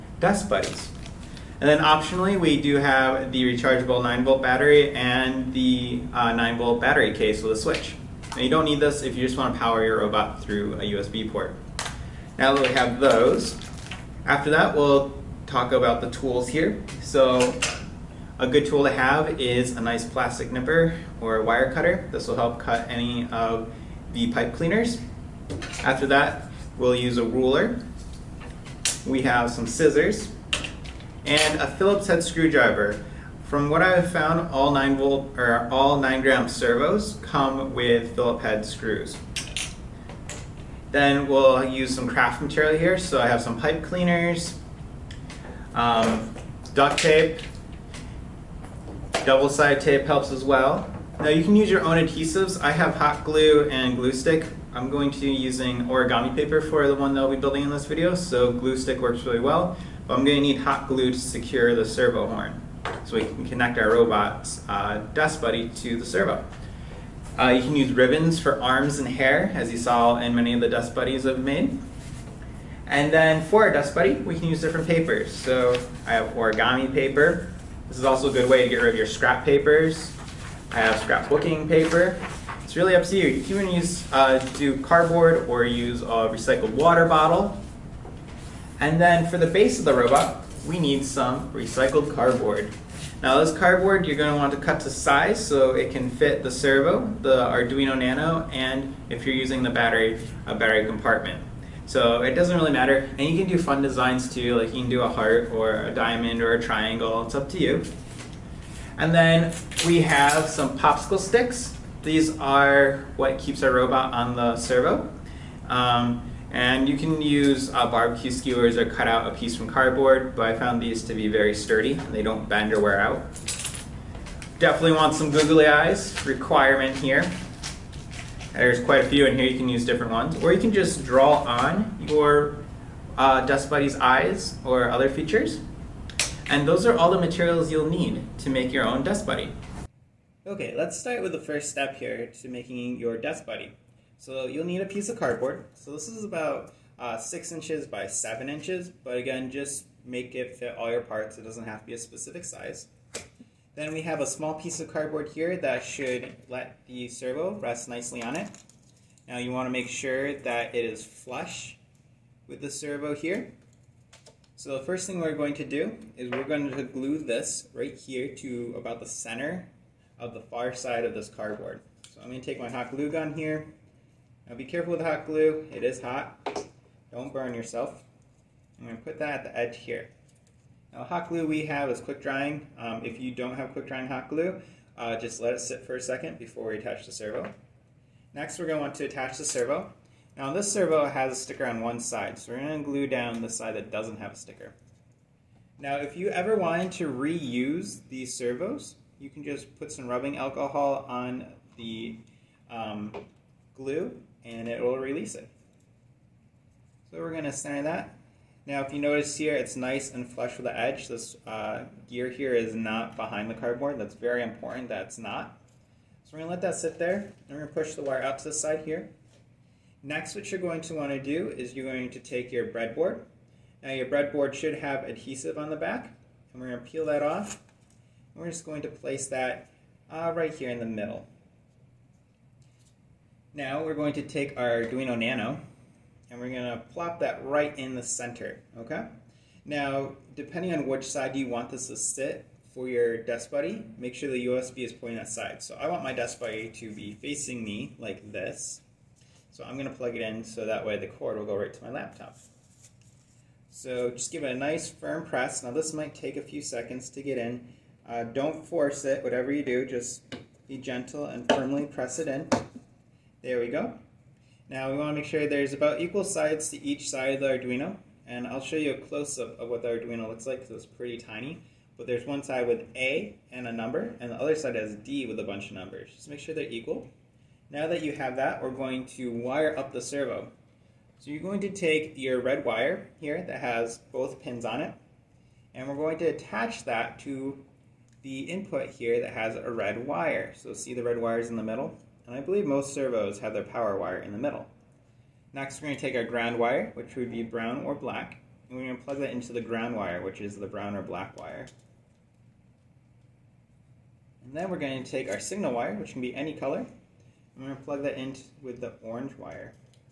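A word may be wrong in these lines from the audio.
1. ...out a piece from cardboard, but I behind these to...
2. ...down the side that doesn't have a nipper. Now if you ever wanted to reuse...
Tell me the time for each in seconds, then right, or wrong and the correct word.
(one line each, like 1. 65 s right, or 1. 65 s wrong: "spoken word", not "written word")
1. 119 s wrong: "found", not "behind"
2. 193 s wrong: "sticker", not "nipper".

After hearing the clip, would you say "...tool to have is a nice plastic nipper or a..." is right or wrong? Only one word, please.
right.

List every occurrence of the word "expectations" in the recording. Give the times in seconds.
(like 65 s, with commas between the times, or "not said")
not said.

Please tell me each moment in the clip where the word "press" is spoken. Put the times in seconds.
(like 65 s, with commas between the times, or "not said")
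255 s, 261 s.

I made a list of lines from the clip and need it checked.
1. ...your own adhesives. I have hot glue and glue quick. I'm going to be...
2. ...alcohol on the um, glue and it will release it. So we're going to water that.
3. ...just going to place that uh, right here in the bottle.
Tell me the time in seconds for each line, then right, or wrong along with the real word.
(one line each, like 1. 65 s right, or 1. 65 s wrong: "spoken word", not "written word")
1. 51 s wrong: "stick", not "quick"
2. 200 s wrong: "center", not "water"
3. 228 s wrong: "middle", not "bottle".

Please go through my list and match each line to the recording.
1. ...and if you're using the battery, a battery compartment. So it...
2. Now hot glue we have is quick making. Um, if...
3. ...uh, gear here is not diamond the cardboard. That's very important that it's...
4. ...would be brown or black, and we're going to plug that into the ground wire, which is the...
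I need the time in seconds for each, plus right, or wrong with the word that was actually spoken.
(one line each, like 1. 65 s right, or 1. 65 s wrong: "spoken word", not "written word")
1. 98 s right
2. 180 s wrong: "drying", not "making"
3. 211 s wrong: "behind", not "diamond"
4. 297 s right.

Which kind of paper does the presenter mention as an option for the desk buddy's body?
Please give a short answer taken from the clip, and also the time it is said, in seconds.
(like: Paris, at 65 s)
scrapbooking paper, at 81 s.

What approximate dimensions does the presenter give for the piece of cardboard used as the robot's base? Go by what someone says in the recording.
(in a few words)
6 inches by 7 inches.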